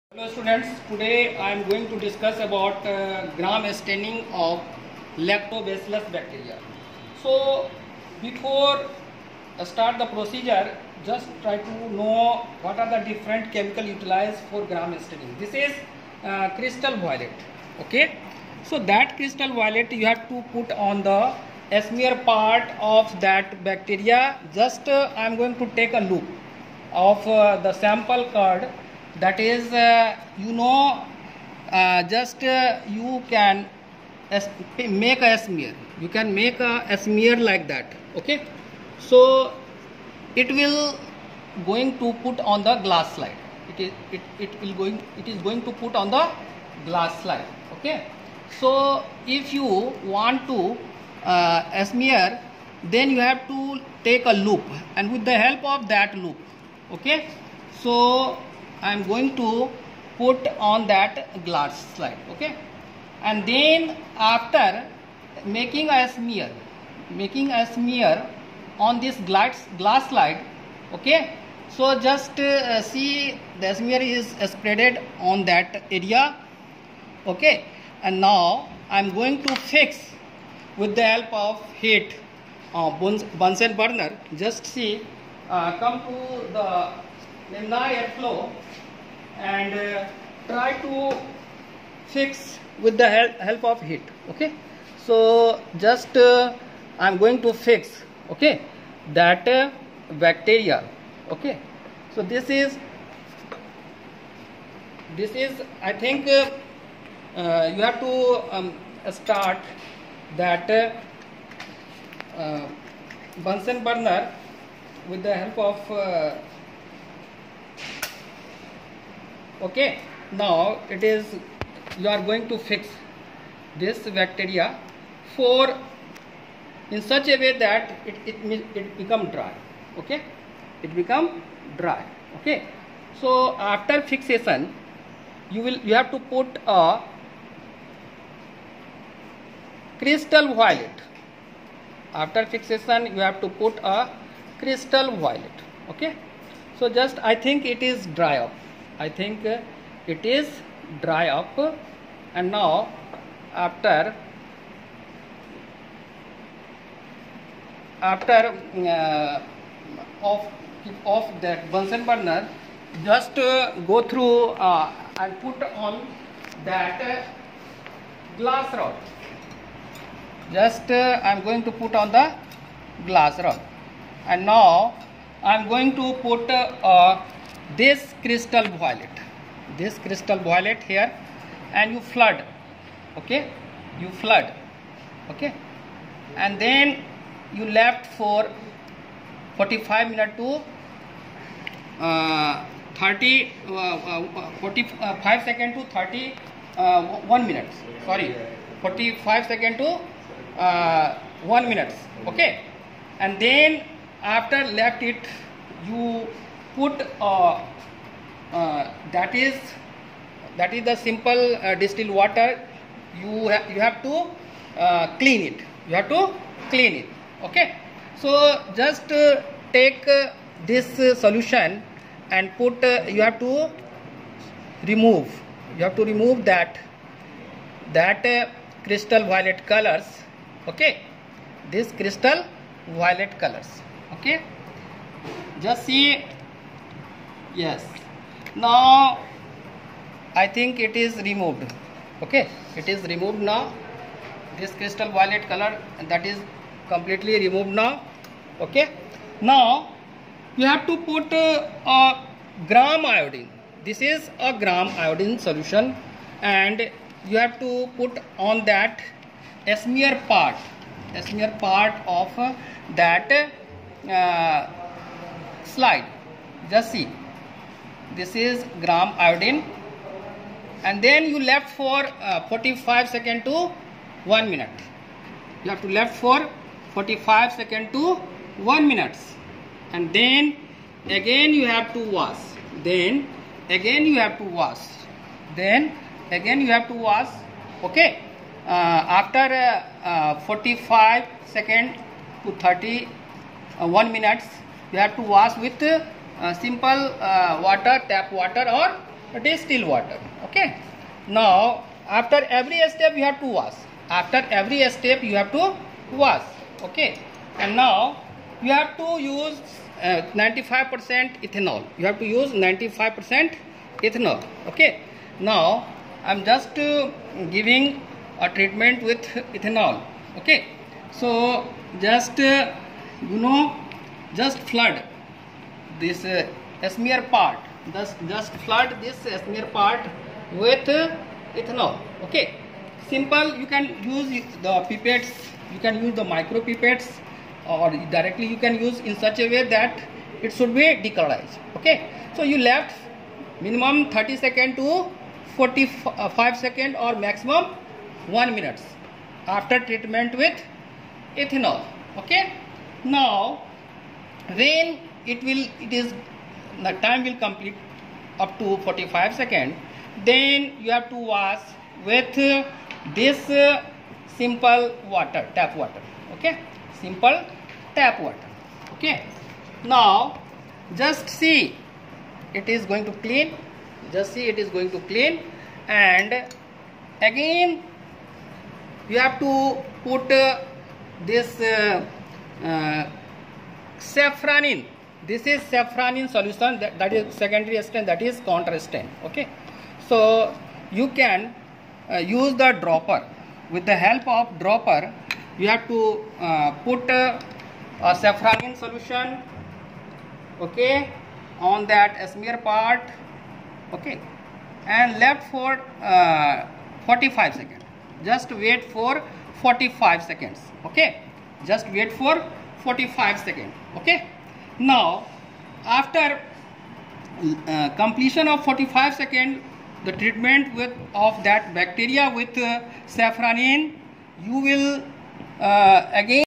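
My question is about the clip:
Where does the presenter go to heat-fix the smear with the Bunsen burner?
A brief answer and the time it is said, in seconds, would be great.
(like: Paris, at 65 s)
Laminar airflow, at 87 s.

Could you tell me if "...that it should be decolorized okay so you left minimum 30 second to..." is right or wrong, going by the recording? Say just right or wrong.
right.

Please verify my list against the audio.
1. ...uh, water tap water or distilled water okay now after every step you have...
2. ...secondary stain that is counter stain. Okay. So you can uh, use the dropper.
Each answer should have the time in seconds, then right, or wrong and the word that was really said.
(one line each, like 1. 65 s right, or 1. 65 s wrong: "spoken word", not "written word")
1. 297 s right
2. 387 s right.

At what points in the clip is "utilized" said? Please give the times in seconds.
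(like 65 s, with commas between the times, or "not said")
13 s.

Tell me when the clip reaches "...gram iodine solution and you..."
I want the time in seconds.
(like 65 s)
254 s.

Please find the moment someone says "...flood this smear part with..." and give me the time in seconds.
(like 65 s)
328 s.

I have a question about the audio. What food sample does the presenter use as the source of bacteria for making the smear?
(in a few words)
Curd.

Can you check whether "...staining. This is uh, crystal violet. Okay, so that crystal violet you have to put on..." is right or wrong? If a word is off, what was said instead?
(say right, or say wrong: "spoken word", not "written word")
right.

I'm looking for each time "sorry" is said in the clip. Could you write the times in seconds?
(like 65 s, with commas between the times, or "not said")
198 s.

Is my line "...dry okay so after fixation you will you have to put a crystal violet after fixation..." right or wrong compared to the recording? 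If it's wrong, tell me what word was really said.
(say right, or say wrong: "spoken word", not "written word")
right.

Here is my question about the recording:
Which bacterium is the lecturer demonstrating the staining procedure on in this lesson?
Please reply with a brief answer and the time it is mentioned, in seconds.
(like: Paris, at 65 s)
Lactobacillus, at 5 s.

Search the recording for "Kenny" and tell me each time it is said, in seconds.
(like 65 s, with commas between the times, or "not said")
not said.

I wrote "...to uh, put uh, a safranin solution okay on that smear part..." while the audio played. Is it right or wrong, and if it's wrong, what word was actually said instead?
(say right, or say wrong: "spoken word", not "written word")
right.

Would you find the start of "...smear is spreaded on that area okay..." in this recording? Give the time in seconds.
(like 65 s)
73 s.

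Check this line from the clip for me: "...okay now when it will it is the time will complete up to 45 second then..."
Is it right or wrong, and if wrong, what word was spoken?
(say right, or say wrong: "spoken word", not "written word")
right.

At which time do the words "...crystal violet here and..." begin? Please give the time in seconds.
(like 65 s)
179 s.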